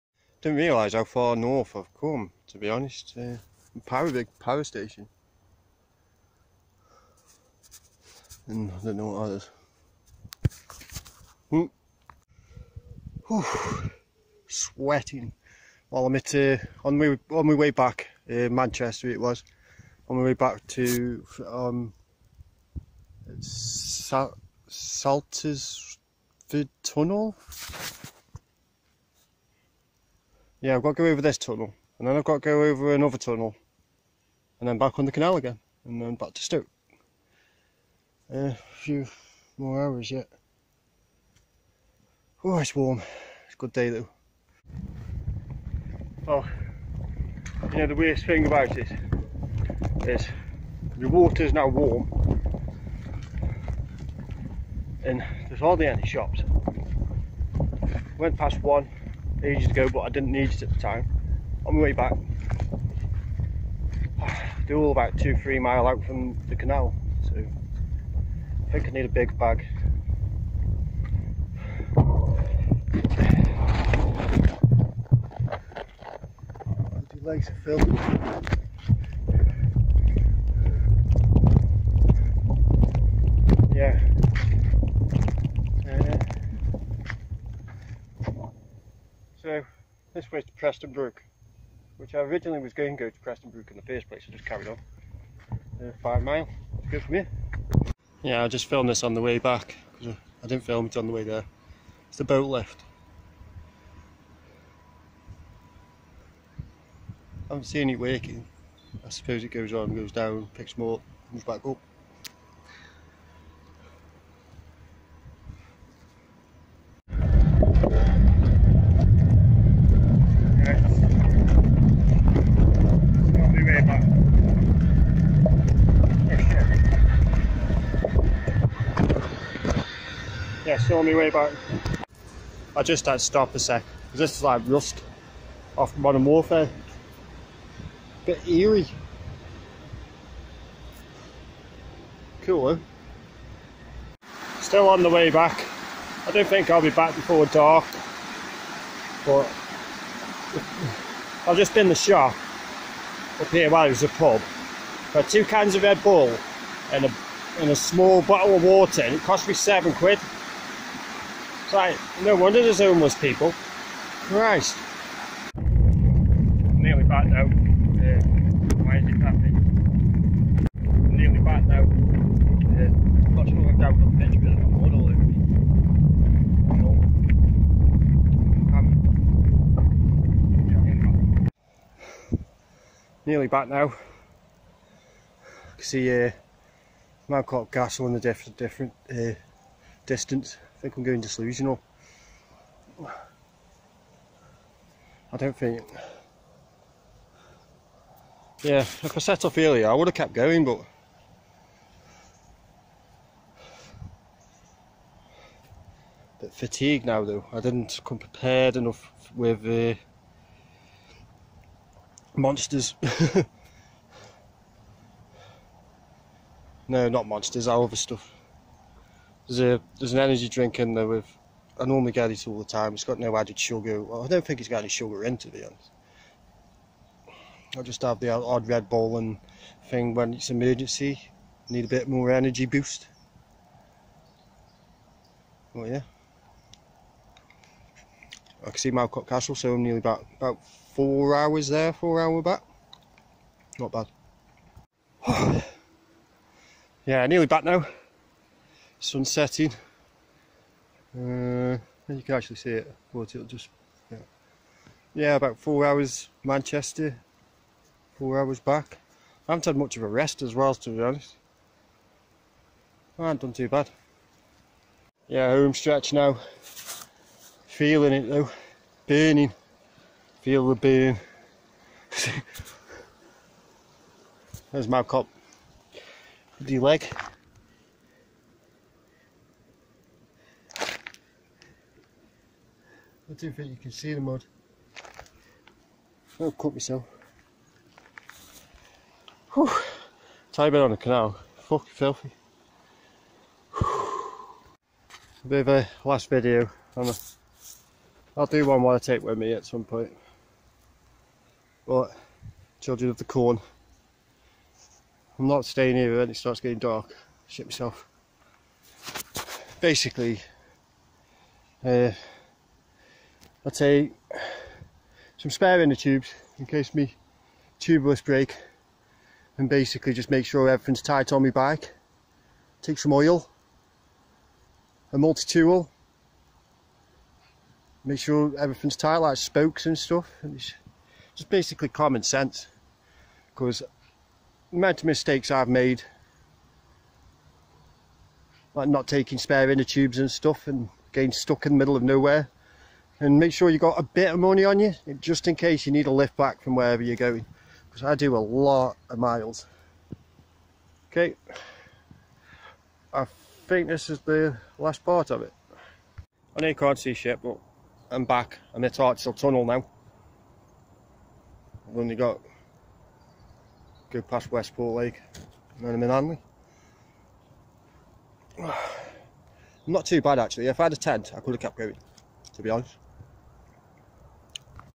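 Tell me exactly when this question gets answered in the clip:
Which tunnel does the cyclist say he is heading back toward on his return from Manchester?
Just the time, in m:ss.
0:23.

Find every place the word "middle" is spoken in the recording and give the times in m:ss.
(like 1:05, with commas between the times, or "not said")
5:41.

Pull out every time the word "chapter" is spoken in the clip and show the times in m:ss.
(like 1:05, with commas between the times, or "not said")
not said.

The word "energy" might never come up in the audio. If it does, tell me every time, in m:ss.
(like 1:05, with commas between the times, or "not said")
3:40, 3:52.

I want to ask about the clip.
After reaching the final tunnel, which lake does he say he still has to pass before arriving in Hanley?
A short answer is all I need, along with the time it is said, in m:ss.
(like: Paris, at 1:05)
Westport Lake, at 6:04.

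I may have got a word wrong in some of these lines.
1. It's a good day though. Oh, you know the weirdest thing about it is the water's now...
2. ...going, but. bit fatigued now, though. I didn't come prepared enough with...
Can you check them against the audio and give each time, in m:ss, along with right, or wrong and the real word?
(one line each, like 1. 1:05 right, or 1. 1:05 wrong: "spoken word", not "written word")
1. 0:43 right
2. 3:20 right.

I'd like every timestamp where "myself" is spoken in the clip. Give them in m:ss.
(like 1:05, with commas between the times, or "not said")
4:46, 5:07.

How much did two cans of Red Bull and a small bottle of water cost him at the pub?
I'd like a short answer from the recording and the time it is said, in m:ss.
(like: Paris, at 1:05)
7 quid, at 2:39.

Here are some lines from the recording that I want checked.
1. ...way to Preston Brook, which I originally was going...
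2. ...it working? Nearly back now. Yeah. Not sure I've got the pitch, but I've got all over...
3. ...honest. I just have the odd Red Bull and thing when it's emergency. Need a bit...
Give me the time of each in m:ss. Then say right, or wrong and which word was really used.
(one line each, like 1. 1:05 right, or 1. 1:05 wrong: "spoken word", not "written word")
1. 1:30 right
2. 2:49 wrong: "happening", not "working"
3. 3:45 right.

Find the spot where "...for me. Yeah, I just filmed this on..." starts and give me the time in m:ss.
1:37.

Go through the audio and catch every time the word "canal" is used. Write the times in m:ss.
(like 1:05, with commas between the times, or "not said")
0:35, 1:06, 4:50.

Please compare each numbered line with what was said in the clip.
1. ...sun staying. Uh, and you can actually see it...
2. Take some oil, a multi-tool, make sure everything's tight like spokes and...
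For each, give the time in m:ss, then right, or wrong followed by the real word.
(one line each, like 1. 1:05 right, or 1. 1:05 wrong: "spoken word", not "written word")
1. 4:09 wrong: "setting", not "staying"
2. 5:22 right.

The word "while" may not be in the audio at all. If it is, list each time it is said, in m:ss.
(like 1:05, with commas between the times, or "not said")
2:33, 4:58.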